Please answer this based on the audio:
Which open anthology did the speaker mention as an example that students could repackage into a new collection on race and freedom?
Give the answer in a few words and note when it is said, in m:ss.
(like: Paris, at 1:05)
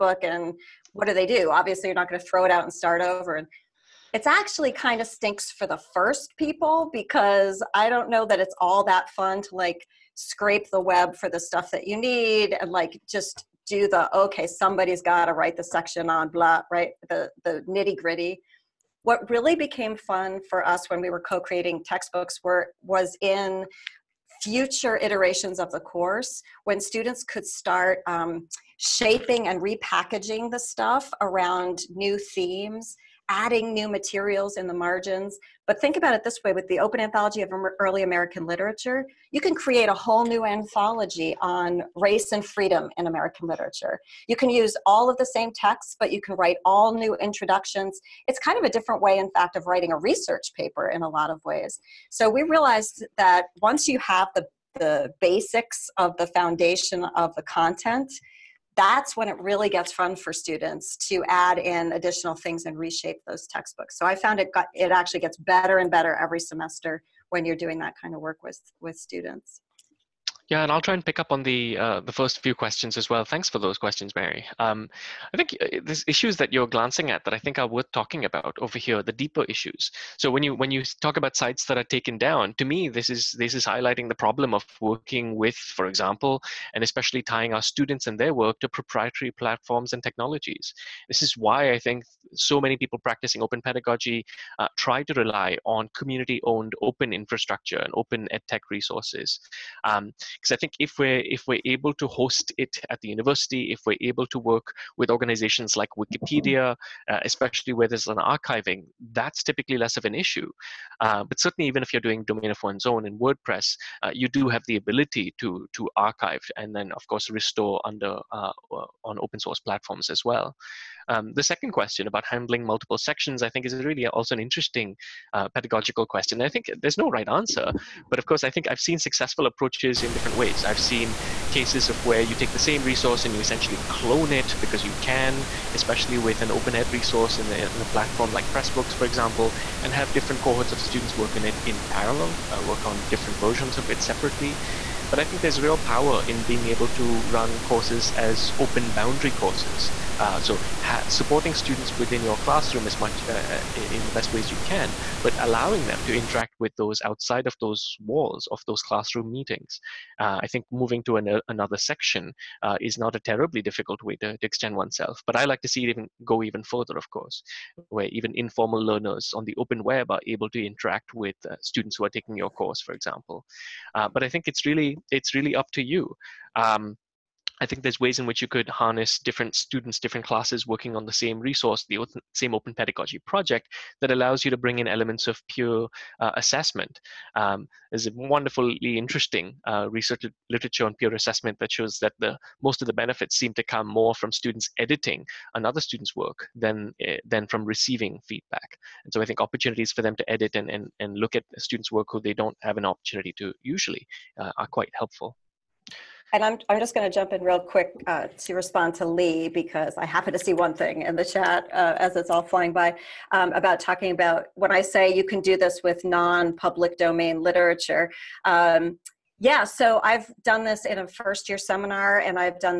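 Open Anthology of Early American Literature, at 0:36.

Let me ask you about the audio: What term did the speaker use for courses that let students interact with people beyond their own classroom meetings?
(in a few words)
open boundary courses.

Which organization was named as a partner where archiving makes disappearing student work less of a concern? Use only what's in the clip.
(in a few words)
Wikipedia.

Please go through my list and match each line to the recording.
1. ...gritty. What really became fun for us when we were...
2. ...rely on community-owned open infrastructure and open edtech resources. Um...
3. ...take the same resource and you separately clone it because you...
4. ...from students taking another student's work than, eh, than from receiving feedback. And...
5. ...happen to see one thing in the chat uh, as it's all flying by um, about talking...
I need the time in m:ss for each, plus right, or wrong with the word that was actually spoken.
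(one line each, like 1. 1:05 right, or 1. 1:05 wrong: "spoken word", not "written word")
1. 0:17 right
2. 1:35 right
3. 2:12 wrong: "essentially", not "separately"
4. 3:14 wrong: "editing", not "taking"
5. 3:30 right.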